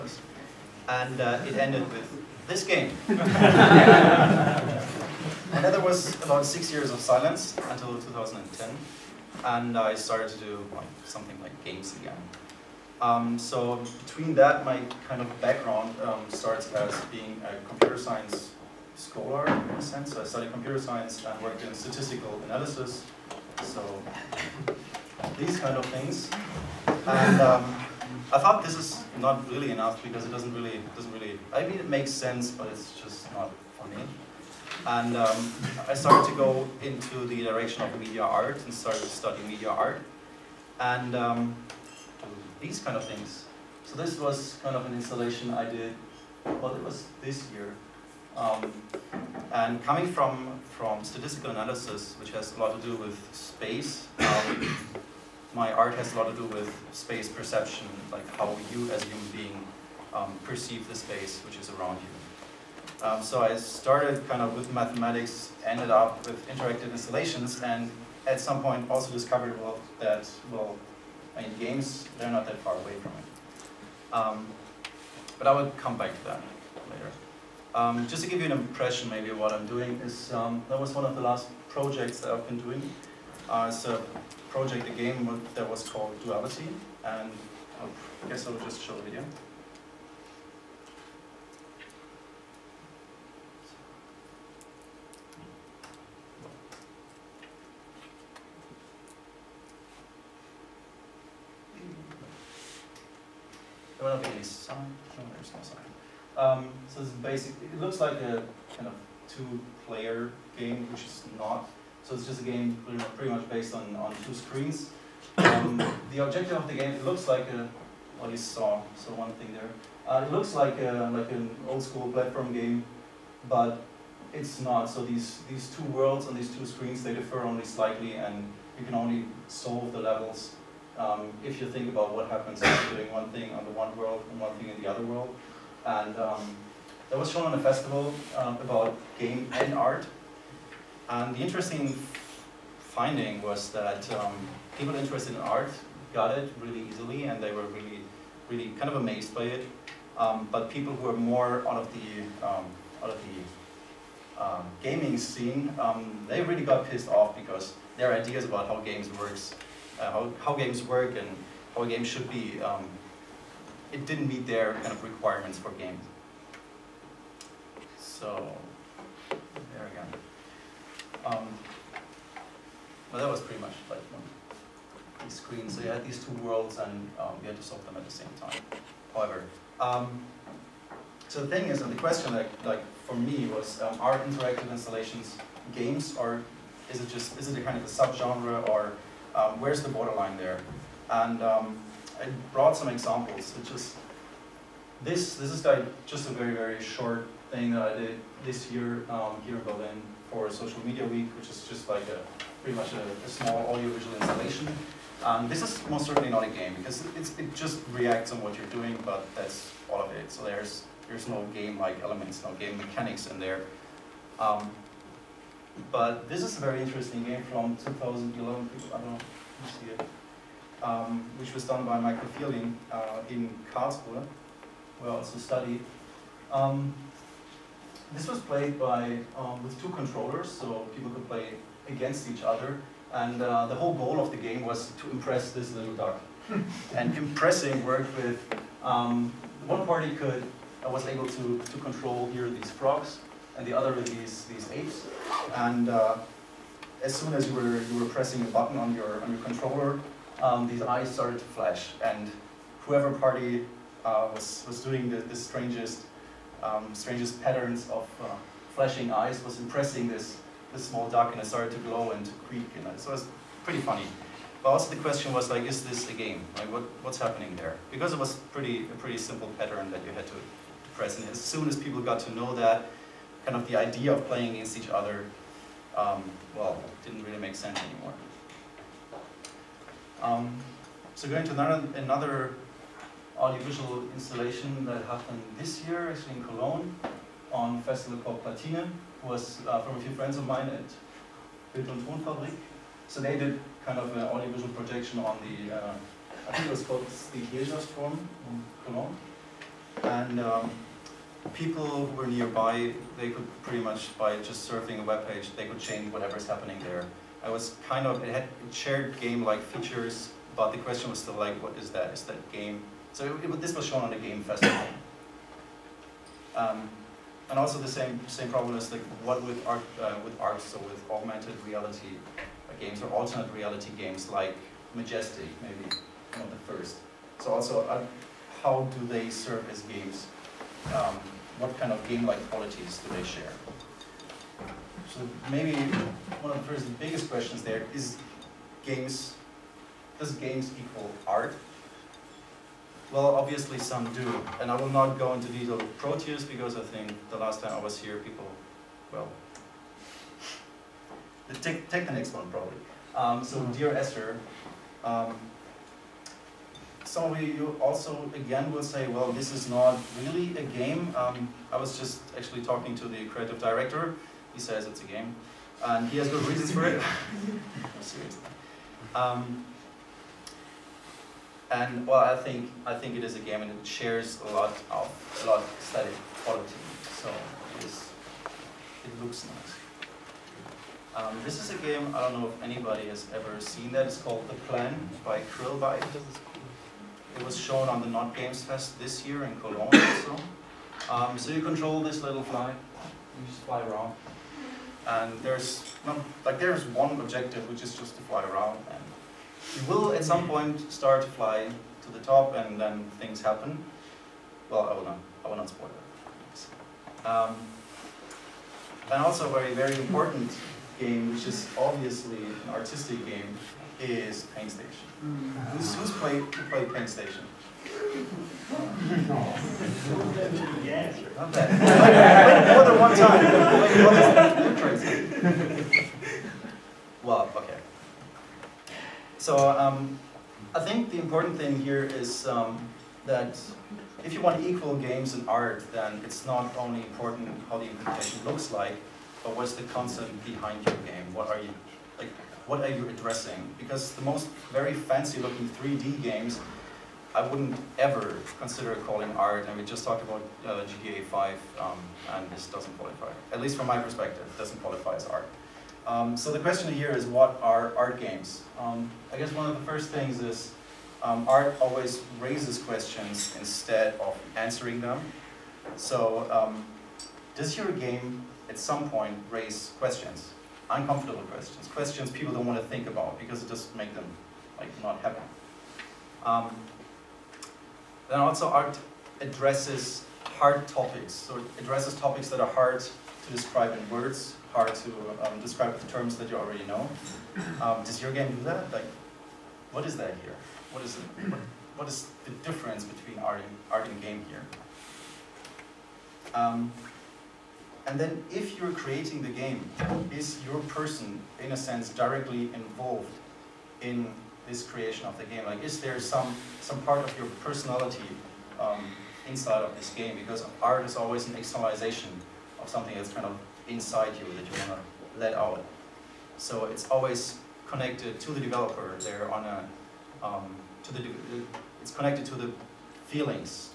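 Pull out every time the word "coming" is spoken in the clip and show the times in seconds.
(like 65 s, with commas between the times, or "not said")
49 s.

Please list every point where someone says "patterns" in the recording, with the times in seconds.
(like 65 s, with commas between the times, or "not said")
257 s, 269 s.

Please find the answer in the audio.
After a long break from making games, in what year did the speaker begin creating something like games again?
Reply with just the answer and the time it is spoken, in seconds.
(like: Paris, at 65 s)
2010, at 7 s.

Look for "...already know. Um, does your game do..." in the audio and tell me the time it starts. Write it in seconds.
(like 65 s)
486 s.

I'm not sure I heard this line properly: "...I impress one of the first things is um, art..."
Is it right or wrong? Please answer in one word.
wrong.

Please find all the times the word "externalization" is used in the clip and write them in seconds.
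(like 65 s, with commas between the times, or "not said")
511 s.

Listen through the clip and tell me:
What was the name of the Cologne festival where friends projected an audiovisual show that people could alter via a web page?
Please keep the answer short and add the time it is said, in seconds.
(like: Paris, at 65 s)
Platine, at 288 s.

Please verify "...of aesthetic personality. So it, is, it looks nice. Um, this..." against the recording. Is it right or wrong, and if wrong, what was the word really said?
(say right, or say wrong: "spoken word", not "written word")
wrong: "quality", not "personality".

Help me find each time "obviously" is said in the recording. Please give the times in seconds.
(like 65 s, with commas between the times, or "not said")
343 s, 411 s.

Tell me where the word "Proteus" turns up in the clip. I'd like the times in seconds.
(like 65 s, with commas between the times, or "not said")
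345 s.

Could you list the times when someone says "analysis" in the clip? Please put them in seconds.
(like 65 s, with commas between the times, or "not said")
22 s, 51 s.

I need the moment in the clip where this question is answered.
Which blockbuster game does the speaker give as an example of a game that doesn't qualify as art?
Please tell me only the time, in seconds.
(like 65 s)
450 s.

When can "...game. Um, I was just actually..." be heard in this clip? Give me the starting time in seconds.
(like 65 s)
360 s.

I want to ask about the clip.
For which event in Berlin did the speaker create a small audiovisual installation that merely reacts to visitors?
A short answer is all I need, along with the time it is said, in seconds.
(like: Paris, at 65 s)
Social Media Week, at 200 s.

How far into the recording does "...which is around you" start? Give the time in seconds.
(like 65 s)
61 s.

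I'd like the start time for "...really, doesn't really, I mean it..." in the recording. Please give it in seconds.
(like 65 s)
30 s.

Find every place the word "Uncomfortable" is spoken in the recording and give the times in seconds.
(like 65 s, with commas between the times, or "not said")
470 s.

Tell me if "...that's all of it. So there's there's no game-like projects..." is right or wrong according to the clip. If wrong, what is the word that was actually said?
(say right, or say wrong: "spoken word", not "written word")
wrong: "elements", not "projects".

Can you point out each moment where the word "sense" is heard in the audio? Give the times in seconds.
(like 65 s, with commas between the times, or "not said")
19 s, 32 s, 277 s, 501 s.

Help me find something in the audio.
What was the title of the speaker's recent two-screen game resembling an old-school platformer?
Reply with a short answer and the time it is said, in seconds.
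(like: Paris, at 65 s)
Duality, at 86 s.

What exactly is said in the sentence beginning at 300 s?
And um, people who were nearby, they could pretty much, by just surfing a web page, they could change whatever's happening there.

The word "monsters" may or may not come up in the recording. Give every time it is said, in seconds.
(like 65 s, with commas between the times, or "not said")
not said.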